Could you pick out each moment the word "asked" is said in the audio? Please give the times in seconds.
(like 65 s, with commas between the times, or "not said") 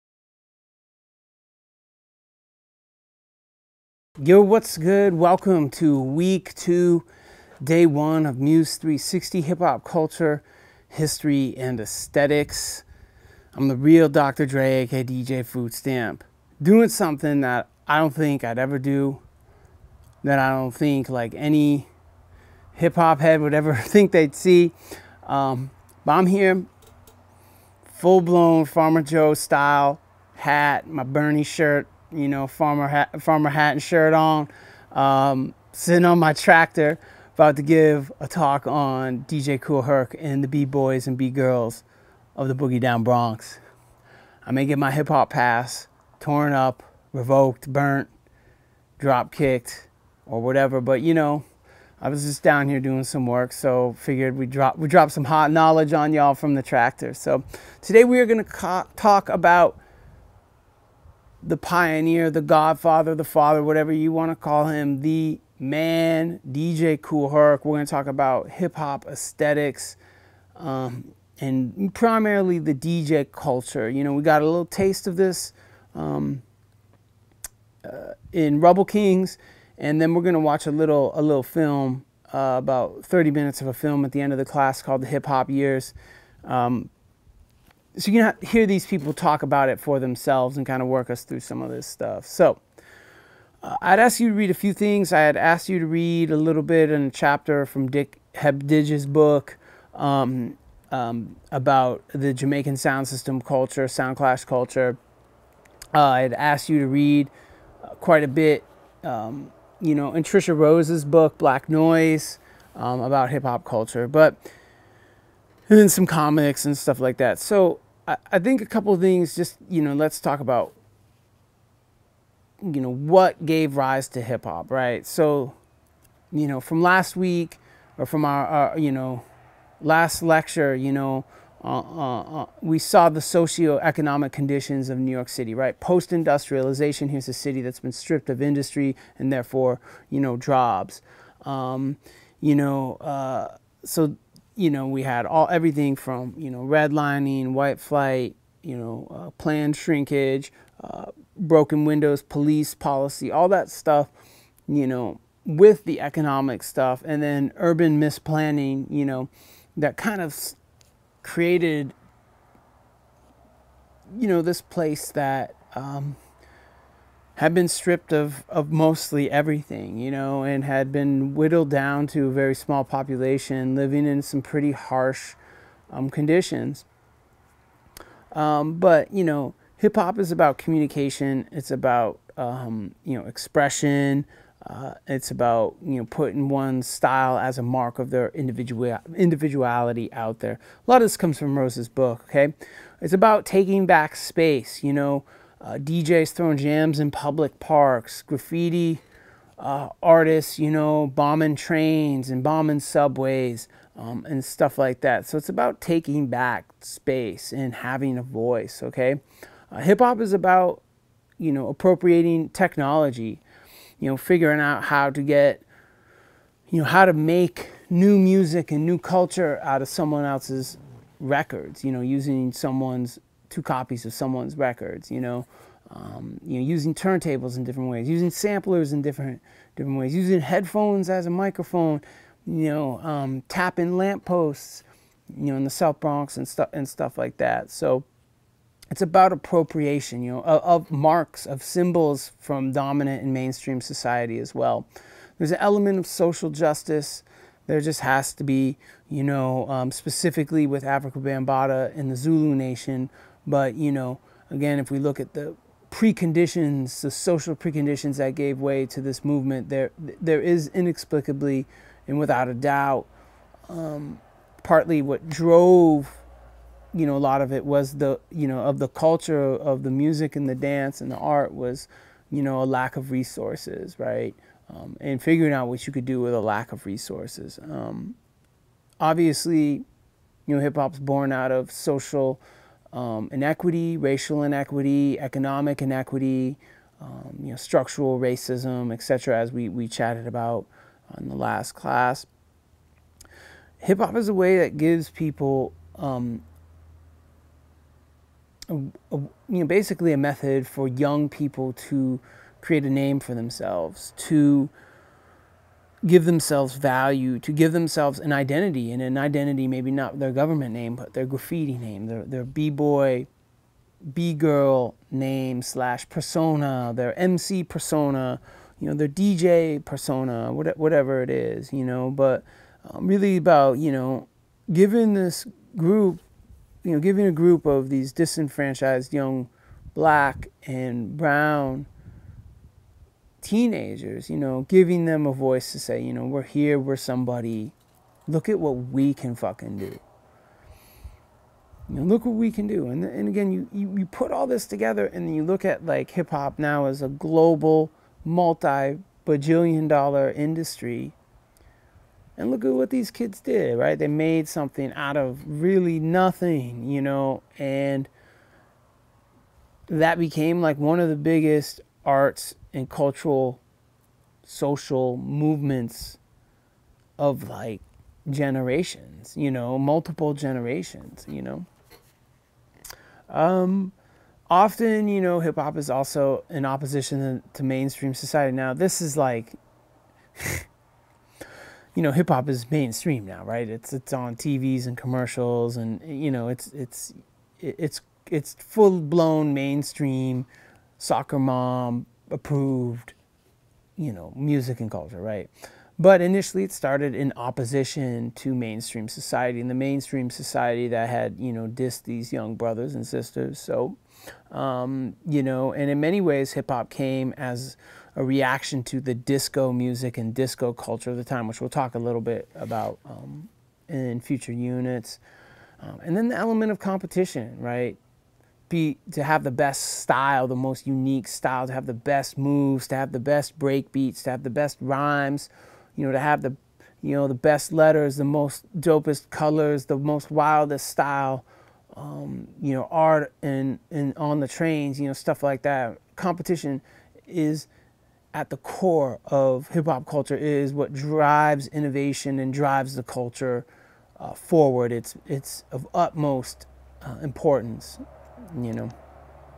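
95 s, 106 s.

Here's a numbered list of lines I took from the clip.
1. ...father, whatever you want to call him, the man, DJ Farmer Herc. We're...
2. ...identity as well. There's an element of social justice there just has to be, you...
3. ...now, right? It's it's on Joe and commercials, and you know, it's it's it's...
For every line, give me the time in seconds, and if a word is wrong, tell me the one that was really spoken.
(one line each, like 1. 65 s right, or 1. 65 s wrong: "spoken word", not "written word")
1. 63 s wrong: "Kool", not "Farmer"
2. 243 s wrong: "society", not "identity"
3. 383 s wrong: "TVs", not "Joe".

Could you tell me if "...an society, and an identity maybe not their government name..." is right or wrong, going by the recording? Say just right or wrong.
wrong.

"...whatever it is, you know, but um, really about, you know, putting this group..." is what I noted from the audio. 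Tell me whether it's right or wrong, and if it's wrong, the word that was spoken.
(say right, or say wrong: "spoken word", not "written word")
wrong: "giving", not "putting".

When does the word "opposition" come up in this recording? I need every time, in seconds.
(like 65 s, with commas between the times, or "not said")
376 s, 397 s.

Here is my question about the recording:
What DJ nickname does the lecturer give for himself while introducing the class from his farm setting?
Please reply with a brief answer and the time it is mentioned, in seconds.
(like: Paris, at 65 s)
DJ Food Stamp, at 15 s.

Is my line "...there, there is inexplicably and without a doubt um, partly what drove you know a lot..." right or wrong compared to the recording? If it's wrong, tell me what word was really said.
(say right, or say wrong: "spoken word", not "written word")
right.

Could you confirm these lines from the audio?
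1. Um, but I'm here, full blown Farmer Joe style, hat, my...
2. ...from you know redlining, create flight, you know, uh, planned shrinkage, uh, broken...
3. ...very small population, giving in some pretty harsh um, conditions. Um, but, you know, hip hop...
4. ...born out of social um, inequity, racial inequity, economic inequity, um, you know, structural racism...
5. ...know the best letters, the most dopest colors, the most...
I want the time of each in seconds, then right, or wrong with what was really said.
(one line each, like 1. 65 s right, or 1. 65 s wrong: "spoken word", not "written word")
1. 25 s right
2. 145 s wrong: "white", not "create"
3. 172 s wrong: "living", not "giving"
4. 280 s right
5. 427 s right.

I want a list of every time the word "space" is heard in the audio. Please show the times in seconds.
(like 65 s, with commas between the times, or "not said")
194 s, 206 s.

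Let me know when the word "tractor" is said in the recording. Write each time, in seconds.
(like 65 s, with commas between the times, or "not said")
36 s, 56 s.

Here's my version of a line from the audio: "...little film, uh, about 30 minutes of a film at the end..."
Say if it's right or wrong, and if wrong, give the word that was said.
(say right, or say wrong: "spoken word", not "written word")
right.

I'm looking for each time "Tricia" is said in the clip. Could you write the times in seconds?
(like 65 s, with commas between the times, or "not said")
110 s.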